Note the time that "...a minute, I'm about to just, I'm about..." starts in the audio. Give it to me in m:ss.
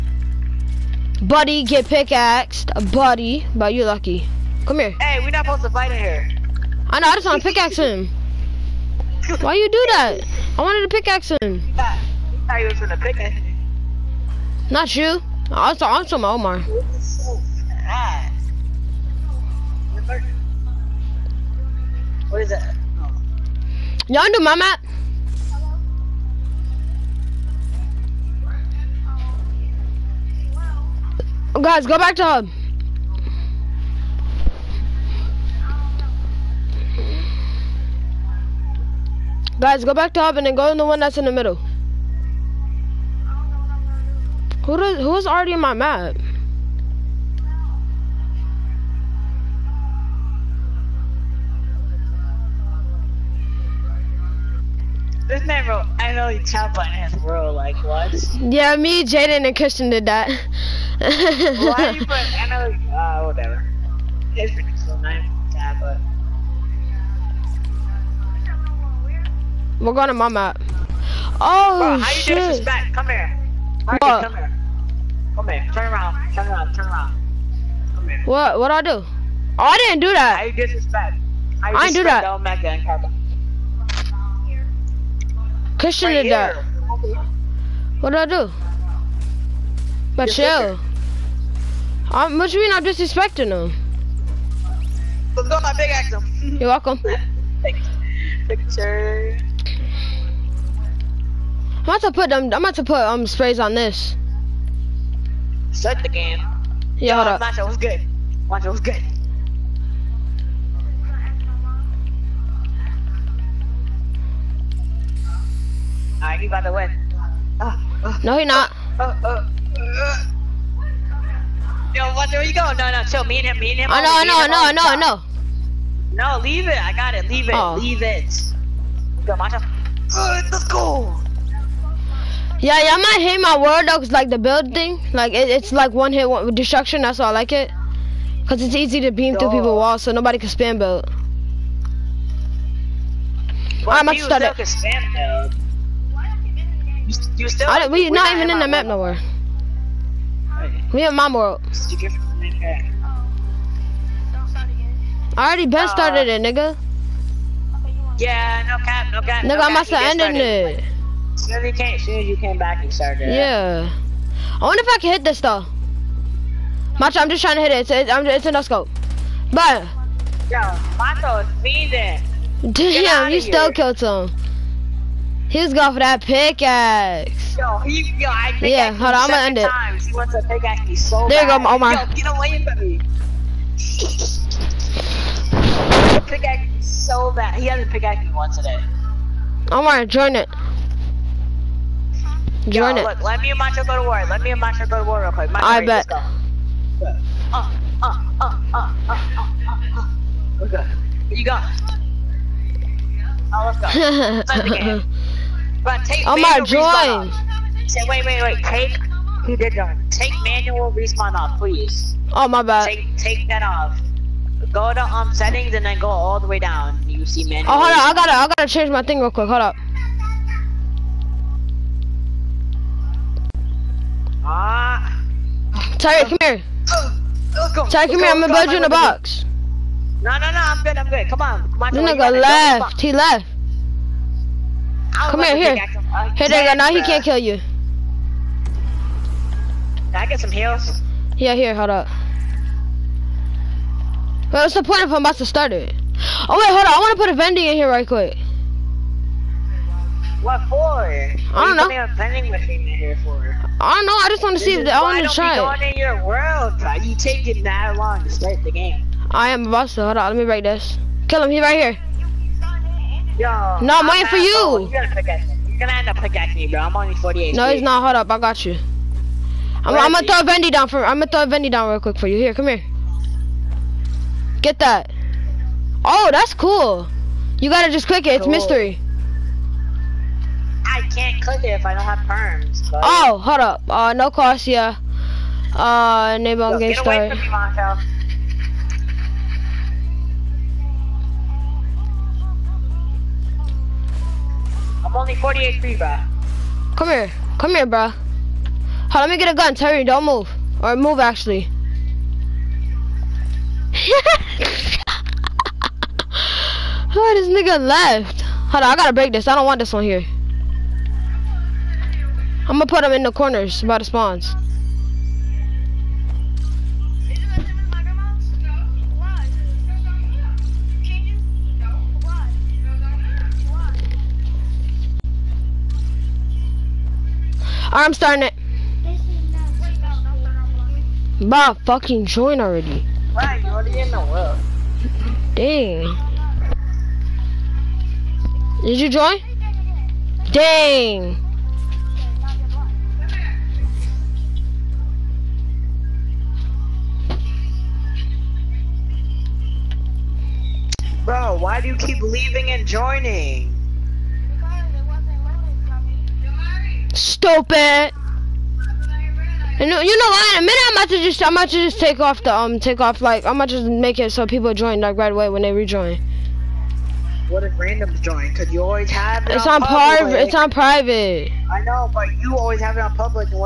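6:00.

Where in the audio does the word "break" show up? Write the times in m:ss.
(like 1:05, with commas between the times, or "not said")
4:20, 5:09.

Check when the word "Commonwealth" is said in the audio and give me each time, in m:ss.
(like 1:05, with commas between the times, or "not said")
not said.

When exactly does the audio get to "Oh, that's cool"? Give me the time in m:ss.
4:36.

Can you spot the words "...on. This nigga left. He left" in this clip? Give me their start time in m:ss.
3:51.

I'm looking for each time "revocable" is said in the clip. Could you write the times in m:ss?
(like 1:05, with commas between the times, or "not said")
not said.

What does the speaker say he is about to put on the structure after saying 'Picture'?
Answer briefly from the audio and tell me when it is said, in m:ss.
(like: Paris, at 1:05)
Sprays, at 1:43.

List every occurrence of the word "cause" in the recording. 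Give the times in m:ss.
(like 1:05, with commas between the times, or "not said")
2:18, 6:08.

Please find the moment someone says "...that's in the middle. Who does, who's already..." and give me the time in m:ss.
0:41.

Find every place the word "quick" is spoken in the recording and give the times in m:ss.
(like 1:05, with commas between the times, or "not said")
3:15, 3:39, 4:08, 4:31.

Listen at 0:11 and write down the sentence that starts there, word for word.
I thought, you was gonna pickaxe him.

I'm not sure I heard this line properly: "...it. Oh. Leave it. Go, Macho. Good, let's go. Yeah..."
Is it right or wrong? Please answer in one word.
right.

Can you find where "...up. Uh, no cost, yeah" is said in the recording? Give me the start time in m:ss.
4:43.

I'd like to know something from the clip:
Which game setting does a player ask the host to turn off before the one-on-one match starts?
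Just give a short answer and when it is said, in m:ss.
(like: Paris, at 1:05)
Manual respawn, at 3:30.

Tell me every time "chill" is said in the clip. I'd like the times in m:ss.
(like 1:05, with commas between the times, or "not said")
1:30, 2:03.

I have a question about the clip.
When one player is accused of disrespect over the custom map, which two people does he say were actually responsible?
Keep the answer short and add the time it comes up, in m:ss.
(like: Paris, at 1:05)
Mecca and Christian, at 1:22.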